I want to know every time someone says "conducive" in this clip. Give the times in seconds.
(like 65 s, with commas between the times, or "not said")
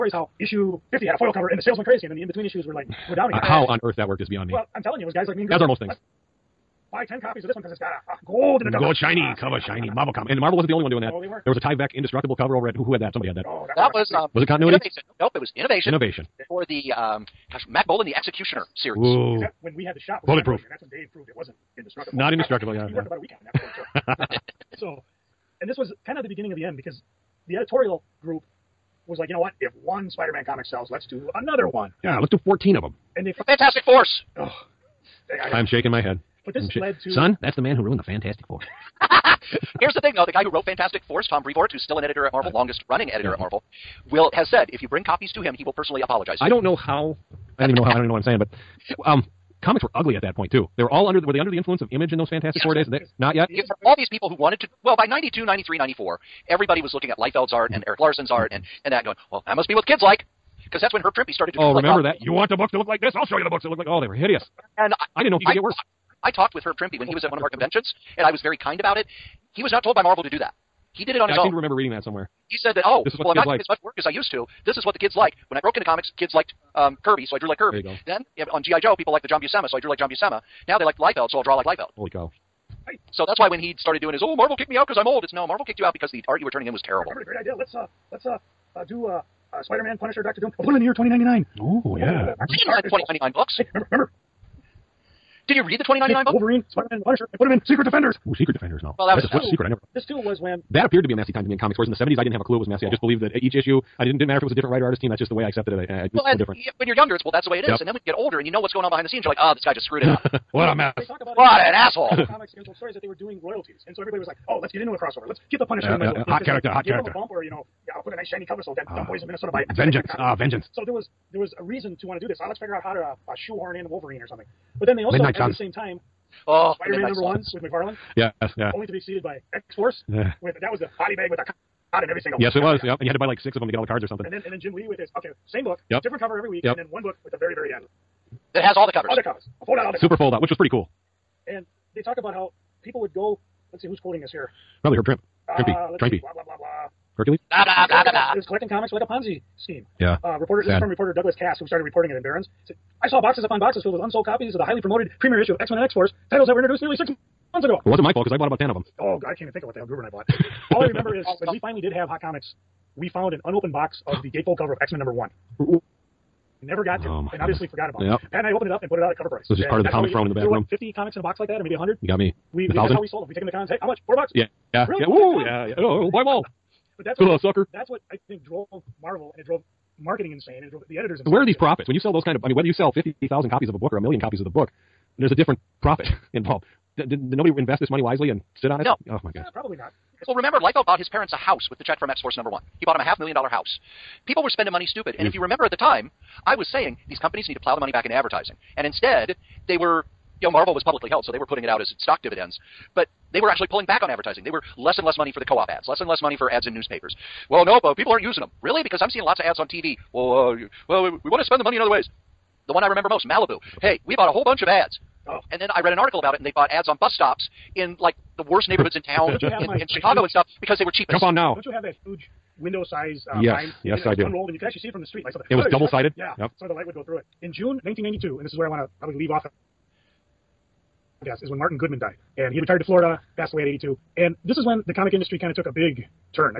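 not said.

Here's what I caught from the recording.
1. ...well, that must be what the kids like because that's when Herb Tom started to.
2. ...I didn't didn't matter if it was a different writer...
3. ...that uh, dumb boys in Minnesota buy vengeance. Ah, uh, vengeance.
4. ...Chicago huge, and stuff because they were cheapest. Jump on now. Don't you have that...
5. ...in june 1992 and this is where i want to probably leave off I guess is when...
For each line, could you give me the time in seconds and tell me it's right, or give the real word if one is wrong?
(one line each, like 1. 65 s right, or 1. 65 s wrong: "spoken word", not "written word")
1. 59 s wrong: "Trimpe", not "Tom"
2. 104 s right
3. 118 s right
4. 219 s right
5. 227 s right.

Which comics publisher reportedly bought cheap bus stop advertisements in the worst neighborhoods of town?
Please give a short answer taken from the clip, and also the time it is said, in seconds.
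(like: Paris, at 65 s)
Malibu, at 213 s.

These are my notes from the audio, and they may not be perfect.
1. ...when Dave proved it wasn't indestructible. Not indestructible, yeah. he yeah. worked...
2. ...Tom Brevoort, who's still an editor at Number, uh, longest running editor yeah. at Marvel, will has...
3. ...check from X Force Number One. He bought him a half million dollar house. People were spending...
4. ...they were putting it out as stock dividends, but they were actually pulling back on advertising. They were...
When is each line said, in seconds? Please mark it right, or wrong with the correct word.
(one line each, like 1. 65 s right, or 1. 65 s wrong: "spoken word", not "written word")
1. 20 s right
2. 41 s wrong: "Marvel", not "Number"
3. 191 s right
4. 201 s right.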